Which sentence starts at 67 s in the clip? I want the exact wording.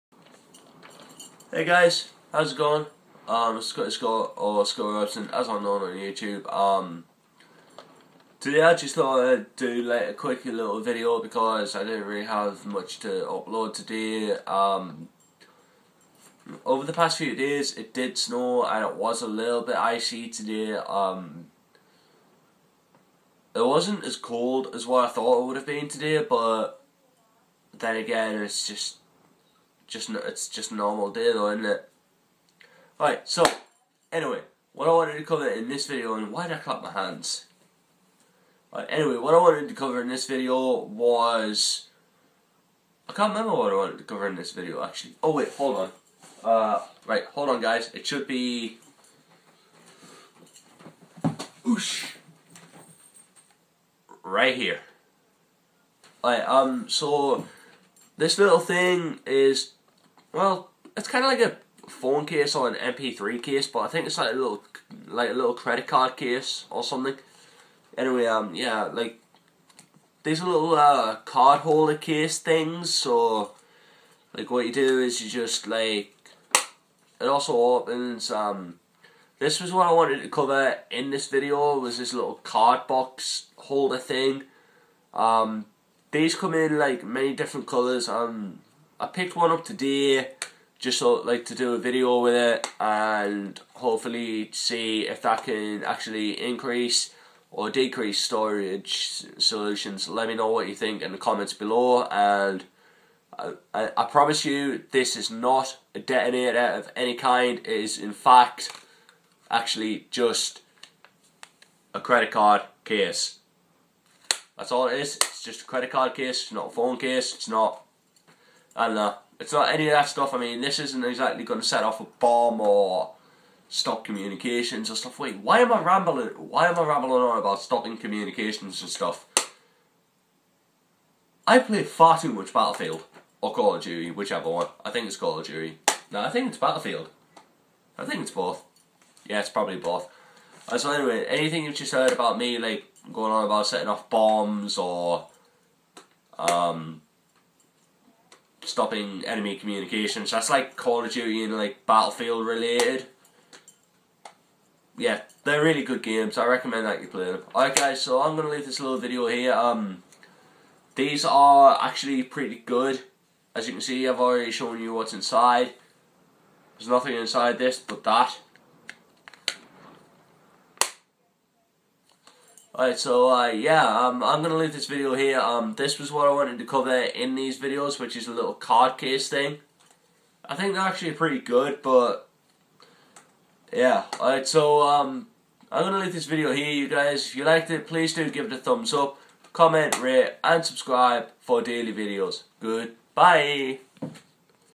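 Anyway, um, yeah, like these little uh, card holder case things.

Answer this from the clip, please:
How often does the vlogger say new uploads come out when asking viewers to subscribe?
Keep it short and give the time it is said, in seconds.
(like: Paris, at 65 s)
Daily, at 191 s.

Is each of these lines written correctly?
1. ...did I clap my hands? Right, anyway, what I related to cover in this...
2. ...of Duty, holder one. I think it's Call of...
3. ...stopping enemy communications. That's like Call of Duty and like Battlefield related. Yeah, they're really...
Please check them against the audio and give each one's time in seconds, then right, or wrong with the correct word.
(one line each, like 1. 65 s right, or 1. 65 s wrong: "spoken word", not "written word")
1. 36 s wrong: "wanted", not "related"
2. 133 s wrong: "whichever", not "holder"
3. 148 s right.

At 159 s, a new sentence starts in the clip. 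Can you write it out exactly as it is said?
Um, These are actually pretty good.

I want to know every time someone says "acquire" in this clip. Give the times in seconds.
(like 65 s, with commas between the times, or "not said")
not said.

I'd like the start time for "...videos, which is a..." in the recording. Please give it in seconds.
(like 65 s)
177 s.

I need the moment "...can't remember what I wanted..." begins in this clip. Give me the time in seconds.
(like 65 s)
43 s.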